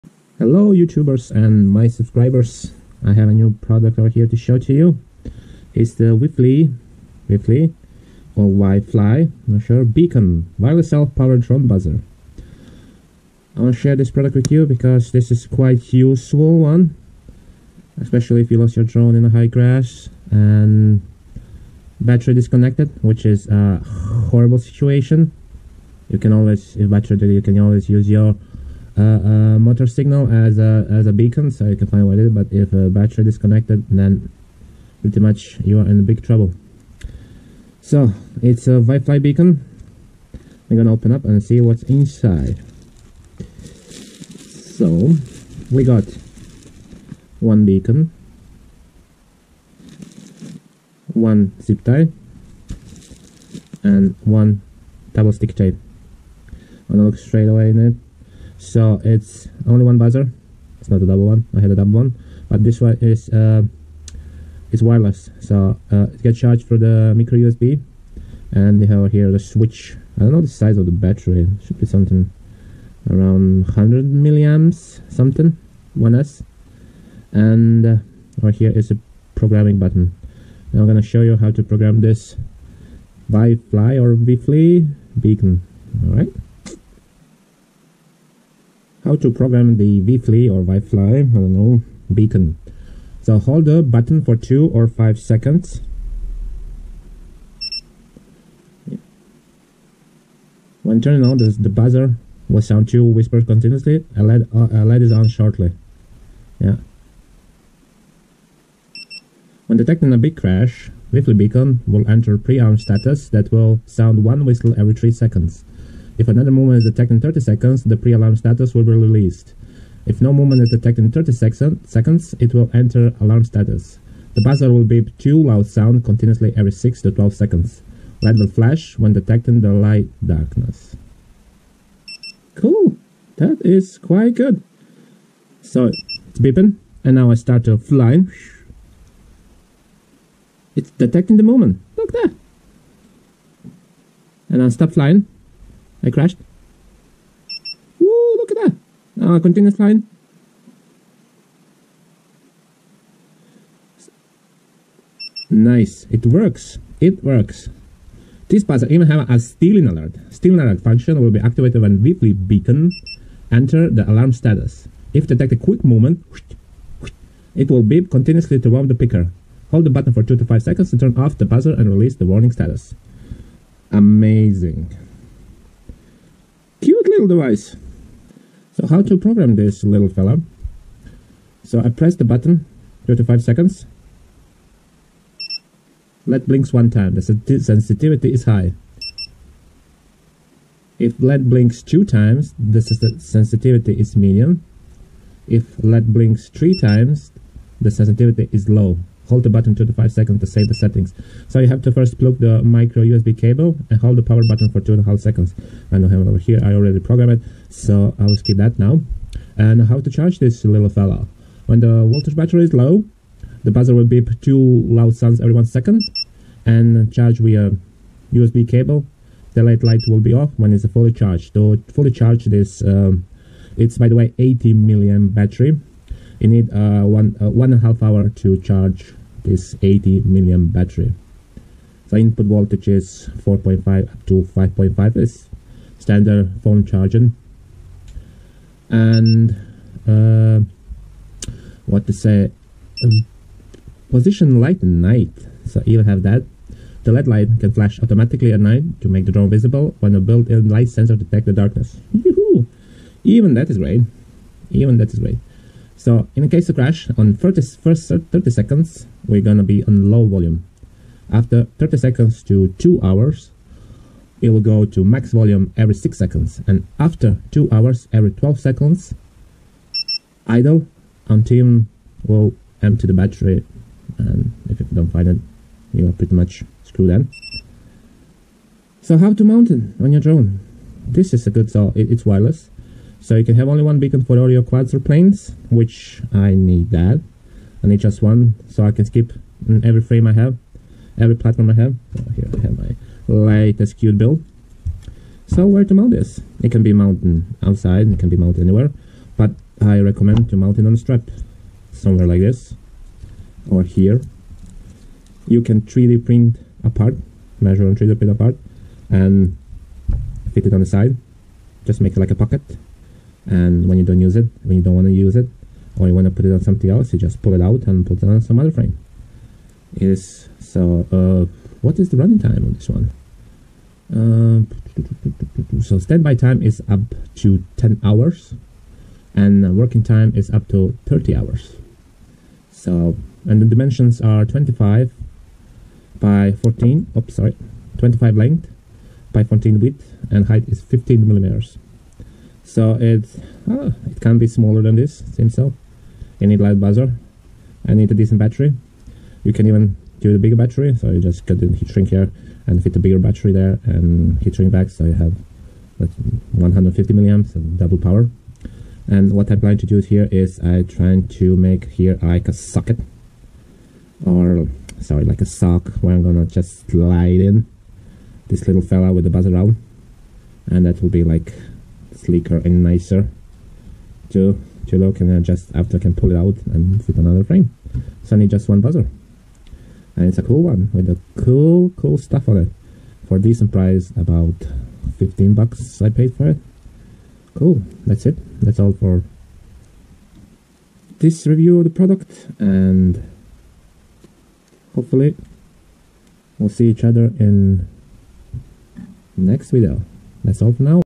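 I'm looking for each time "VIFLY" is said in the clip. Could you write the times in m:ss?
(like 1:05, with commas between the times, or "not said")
1:51, 2:41.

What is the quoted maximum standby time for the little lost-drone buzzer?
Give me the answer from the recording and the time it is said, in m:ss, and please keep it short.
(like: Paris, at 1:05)
10 hours, at 5:27.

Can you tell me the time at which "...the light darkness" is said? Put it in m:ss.
2:09.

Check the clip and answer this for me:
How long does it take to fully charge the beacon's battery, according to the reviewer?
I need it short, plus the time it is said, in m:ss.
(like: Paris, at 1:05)
1.5 hours, at 3:47.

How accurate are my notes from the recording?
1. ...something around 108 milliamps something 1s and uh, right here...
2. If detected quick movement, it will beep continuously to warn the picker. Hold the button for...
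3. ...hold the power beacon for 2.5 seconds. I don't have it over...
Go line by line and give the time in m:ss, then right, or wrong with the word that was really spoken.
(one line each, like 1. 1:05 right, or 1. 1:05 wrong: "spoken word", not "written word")
1. 1:11 wrong: "100", not "108"
2. 2:45 right
3. 3:24 wrong: "button", not "beacon".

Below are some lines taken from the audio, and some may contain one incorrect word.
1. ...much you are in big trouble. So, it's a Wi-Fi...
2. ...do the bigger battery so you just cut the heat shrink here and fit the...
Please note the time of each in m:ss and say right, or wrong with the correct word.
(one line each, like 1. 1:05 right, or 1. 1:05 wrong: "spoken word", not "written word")
1. 0:35 right
2. 5:50 right.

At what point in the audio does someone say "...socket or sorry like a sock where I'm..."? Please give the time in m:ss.
6:02.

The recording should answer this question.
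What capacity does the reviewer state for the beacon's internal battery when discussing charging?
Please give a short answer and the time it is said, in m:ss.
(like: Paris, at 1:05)
80 milliamp, at 3:44.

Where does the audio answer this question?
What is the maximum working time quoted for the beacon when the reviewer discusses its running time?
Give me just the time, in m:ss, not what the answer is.
5:31.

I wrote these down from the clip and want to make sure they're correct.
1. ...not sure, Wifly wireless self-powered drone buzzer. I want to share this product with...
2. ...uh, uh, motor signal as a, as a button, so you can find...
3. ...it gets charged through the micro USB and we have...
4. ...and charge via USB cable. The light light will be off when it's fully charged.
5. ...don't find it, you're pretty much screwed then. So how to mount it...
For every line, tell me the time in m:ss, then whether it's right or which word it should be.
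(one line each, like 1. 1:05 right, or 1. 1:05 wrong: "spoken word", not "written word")
1. 0:09 wrong: "Beacon", not "Wifly"
2. 0:29 wrong: "beacon", not "button"
3. 1:06 right
4. 3:36 right
5. 4:34 right.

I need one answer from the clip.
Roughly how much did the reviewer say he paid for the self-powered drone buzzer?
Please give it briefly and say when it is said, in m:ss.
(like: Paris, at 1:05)
$15, at 6:25.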